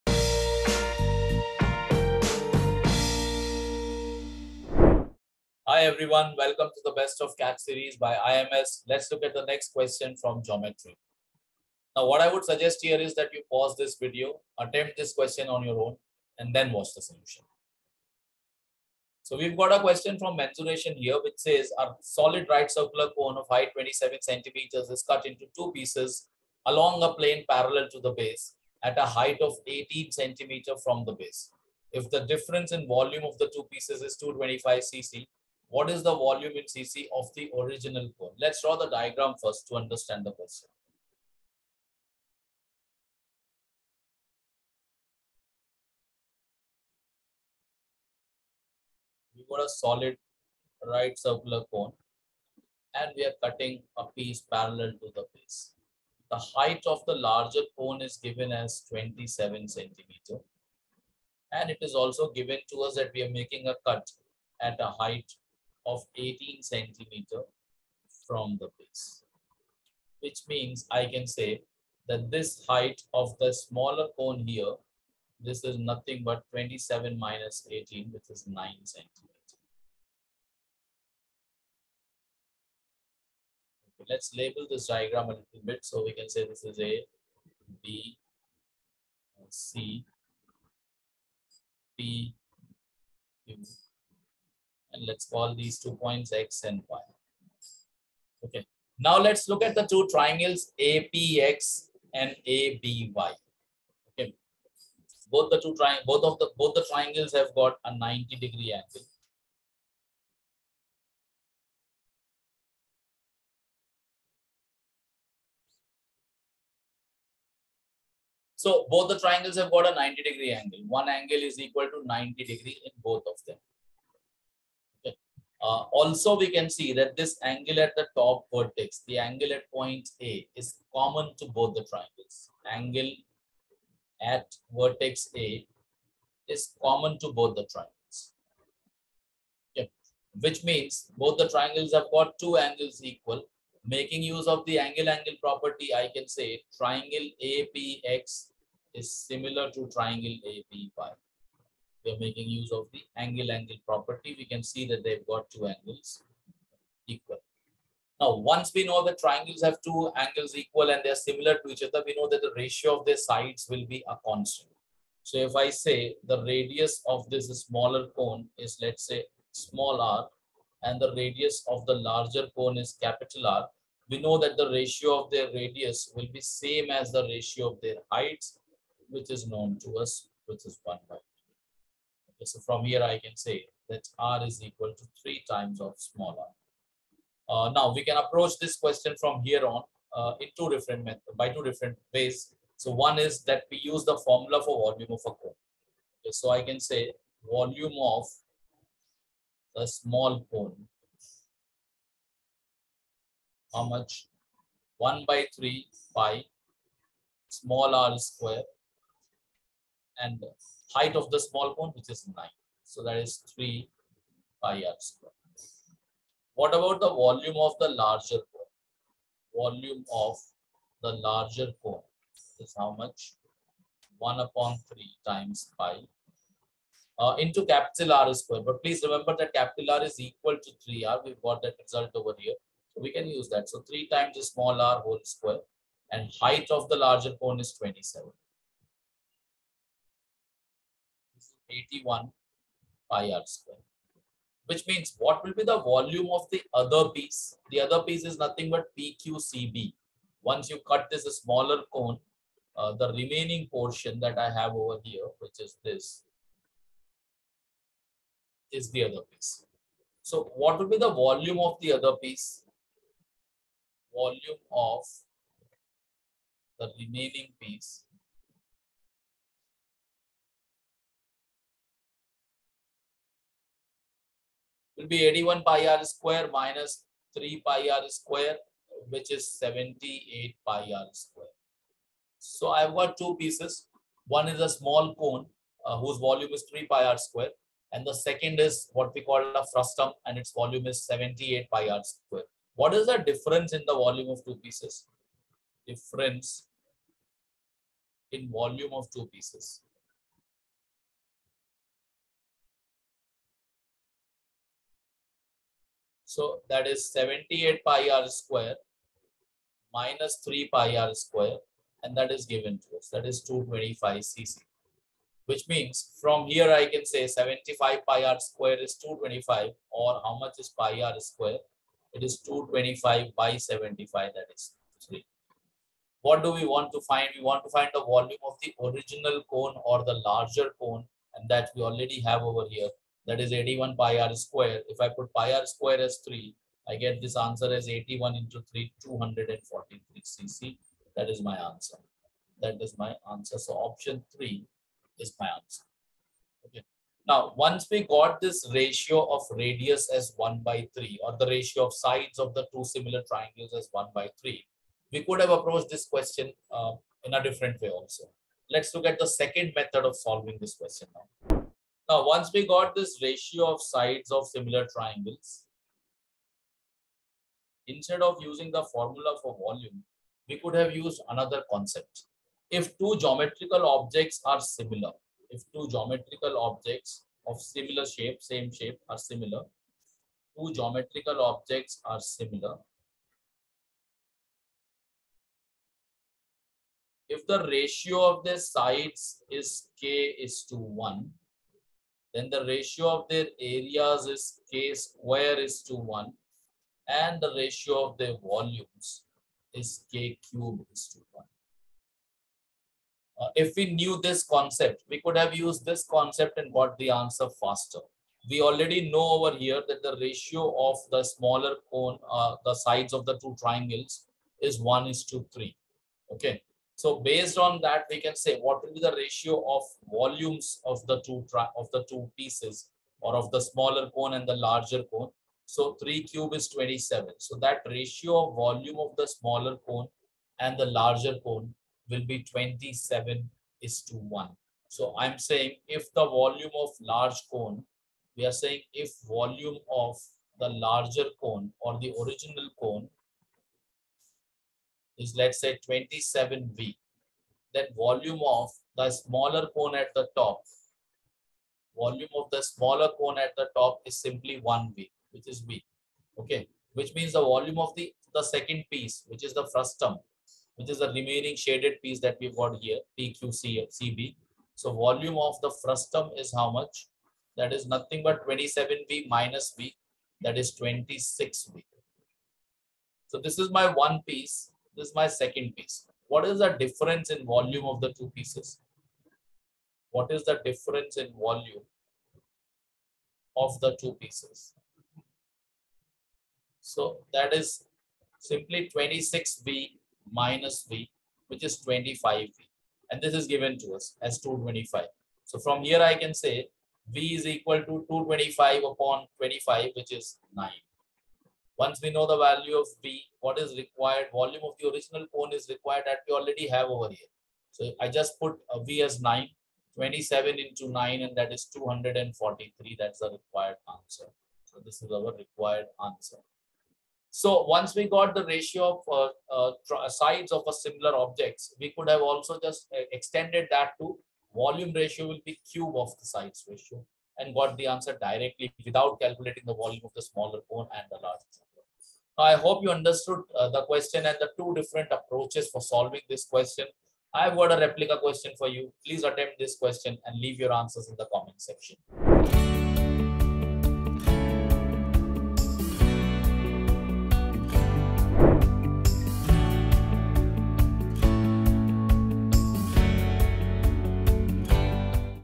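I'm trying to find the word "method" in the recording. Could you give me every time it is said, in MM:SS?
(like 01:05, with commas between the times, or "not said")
03:11, 05:59.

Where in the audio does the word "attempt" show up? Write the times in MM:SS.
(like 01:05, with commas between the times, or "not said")
00:14, 08:59.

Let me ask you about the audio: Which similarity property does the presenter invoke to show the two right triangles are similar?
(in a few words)
angle-angle property.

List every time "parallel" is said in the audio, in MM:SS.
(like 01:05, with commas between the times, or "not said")
00:27, 00:54.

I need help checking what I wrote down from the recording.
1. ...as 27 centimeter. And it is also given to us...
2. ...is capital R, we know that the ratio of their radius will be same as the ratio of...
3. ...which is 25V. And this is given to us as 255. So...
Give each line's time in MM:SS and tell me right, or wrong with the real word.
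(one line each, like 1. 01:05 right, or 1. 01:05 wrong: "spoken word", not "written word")
1. 00:58 right
2. 02:52 right
3. 08:11 wrong: "225", not "255".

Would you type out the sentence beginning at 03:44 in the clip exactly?
1 upon 3 times pi uh, into capital R square.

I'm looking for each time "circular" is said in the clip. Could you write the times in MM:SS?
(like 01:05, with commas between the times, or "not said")
00:22, 00:51.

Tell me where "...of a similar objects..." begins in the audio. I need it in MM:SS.
08:40.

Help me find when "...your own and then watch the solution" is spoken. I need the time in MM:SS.
00:15.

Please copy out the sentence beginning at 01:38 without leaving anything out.
Okay, now let's look at the two triangles APX and ABY.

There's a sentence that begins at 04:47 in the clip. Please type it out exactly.
And the second is what we call a frustum and its volume is 78 pi r square.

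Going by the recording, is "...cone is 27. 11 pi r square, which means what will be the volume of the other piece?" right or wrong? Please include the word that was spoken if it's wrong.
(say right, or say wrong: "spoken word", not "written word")
wrong: "81", not "11".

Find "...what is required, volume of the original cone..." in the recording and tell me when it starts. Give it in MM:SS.
08:23.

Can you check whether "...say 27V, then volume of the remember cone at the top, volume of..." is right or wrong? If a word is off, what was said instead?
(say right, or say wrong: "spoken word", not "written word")
wrong: "smaller", not "remember".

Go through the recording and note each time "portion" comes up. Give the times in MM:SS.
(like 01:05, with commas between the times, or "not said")
04:13.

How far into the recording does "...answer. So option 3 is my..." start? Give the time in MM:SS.
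05:43.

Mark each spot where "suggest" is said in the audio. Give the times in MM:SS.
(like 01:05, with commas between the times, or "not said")
00:12.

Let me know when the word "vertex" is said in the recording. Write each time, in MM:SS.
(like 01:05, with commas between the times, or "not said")
02:08, 02:14.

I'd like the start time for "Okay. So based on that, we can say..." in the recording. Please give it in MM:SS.
06:56.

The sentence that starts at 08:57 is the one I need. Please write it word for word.
I've got a replica question for you.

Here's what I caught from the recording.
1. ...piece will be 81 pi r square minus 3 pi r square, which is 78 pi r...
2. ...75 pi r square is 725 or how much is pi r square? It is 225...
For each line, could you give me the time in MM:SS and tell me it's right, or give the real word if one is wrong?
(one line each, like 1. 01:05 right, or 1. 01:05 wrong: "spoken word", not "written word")
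1. 04:27 right
2. 05:17 wrong: "225", not "725".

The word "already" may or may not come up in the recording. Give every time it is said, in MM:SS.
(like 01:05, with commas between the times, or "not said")
05:31, 06:48, 08:26.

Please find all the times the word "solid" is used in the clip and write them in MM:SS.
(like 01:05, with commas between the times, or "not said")
00:22, 00:49.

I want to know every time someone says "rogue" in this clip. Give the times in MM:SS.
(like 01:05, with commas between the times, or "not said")
not said.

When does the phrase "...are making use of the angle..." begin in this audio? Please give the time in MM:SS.
02:32.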